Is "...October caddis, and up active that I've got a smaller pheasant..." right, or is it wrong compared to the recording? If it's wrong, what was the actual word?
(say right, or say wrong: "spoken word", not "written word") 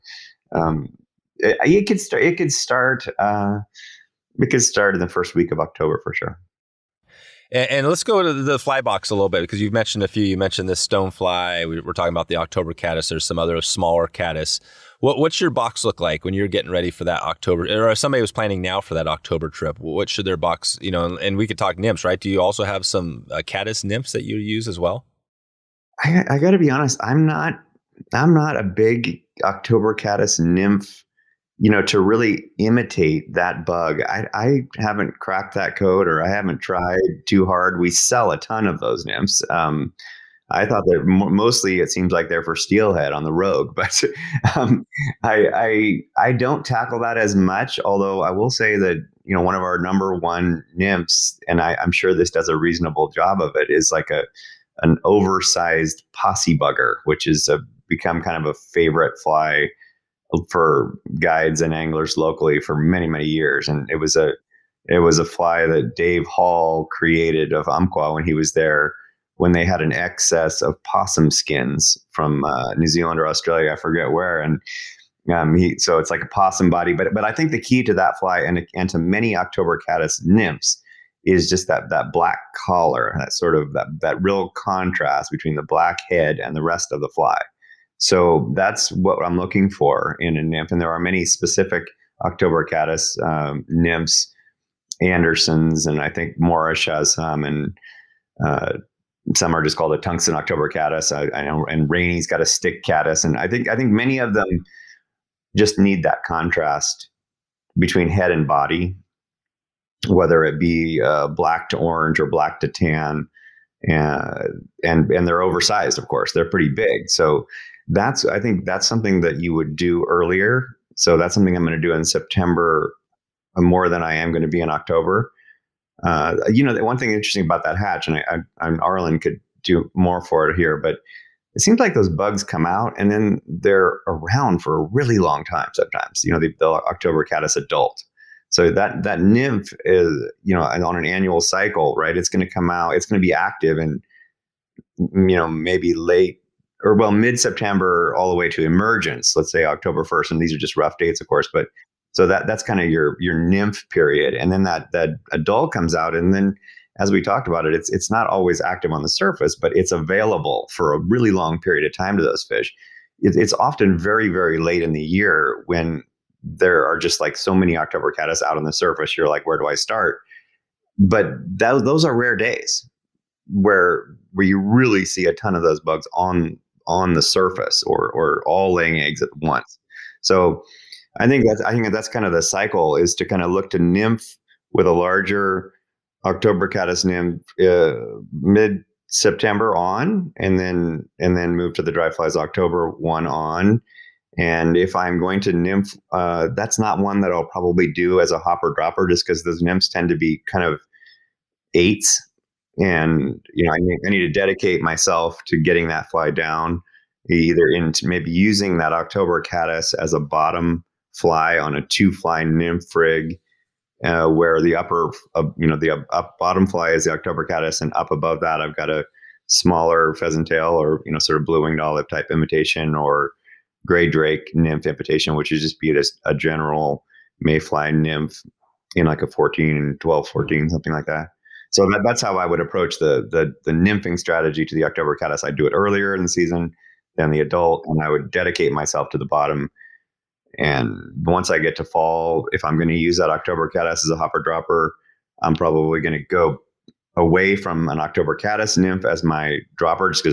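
wrong: "above", not "active".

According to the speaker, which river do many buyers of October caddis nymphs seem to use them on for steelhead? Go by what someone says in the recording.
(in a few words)
the Rogue.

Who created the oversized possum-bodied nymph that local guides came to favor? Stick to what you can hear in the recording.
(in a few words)
Dave Hall.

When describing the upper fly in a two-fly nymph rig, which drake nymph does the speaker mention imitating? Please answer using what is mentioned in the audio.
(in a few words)
gray drake.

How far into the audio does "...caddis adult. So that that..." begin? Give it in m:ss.
2:17.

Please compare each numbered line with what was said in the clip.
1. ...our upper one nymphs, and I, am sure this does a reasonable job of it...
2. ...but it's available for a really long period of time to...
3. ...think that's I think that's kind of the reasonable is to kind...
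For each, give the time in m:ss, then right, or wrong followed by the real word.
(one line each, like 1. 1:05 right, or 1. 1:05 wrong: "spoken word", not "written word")
1. 0:49 wrong: "number", not "upper"
2. 2:39 right
3. 3:01 wrong: "cycle", not "reasonable".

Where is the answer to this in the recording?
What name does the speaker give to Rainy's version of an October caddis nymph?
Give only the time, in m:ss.
1:42.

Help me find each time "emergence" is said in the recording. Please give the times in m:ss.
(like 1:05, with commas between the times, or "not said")
2:28.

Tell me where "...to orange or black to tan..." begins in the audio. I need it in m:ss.
1:51.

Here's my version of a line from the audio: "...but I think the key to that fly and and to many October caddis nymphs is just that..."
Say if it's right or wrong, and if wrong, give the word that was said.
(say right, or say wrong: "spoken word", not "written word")
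right.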